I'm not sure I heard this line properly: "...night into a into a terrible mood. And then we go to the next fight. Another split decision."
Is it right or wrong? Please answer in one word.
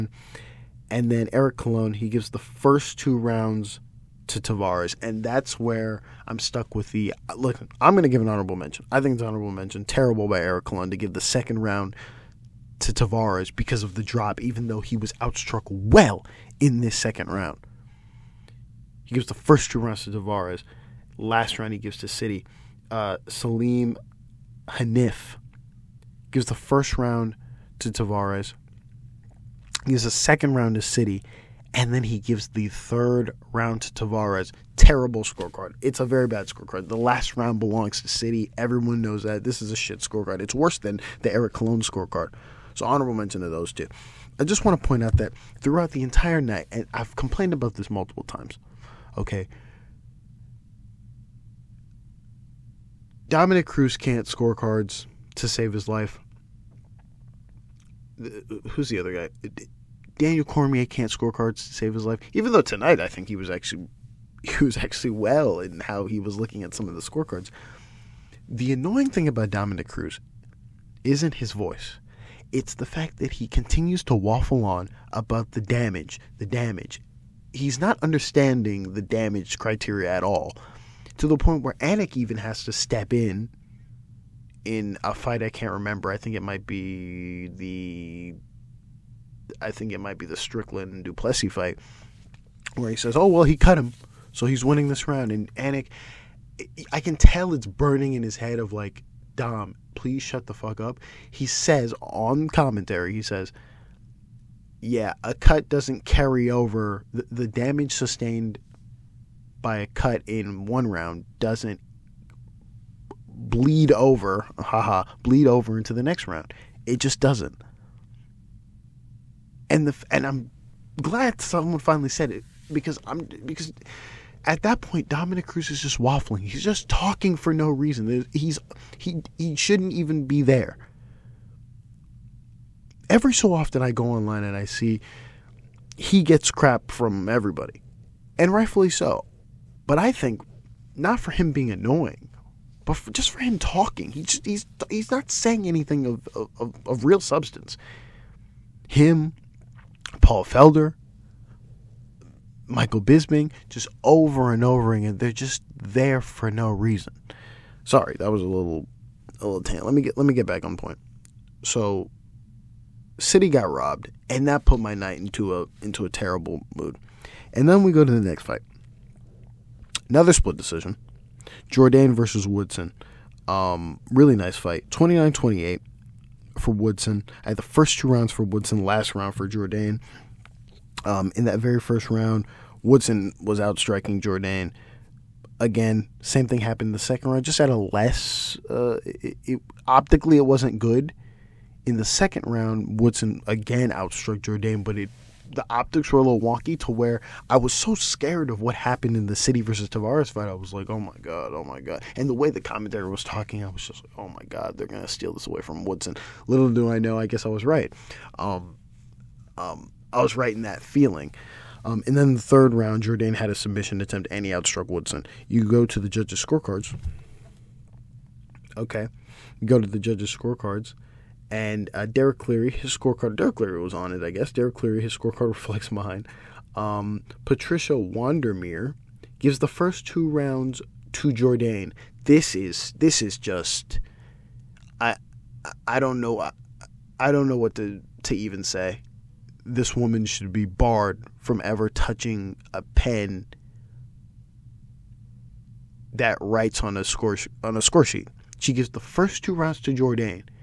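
right.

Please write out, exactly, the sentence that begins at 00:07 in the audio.
I'm going to give an honorable mention.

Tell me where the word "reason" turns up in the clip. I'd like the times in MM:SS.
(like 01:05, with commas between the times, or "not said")
02:07, 02:36.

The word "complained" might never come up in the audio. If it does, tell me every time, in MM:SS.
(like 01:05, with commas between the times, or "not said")
00:47.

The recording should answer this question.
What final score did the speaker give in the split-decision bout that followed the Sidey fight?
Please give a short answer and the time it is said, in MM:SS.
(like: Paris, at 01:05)
29-28 for Woodson, at 02:54.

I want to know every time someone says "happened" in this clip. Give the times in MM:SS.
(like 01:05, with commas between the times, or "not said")
03:06, 03:18.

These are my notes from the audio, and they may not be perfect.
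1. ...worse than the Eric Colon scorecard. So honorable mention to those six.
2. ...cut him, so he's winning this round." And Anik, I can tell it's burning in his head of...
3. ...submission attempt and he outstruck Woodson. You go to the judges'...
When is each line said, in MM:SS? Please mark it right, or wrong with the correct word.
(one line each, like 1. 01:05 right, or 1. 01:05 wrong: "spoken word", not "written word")
1. 00:40 wrong: "two", not "six"
2. 01:33 right
3. 03:33 right.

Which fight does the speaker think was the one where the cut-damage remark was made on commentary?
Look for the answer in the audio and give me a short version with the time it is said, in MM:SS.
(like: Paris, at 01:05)
Strickland and Du Plessis, at 01:30.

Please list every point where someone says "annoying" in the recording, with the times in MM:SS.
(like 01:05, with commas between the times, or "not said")
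01:08, 02:21.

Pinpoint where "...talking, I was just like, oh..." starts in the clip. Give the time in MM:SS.
03:23.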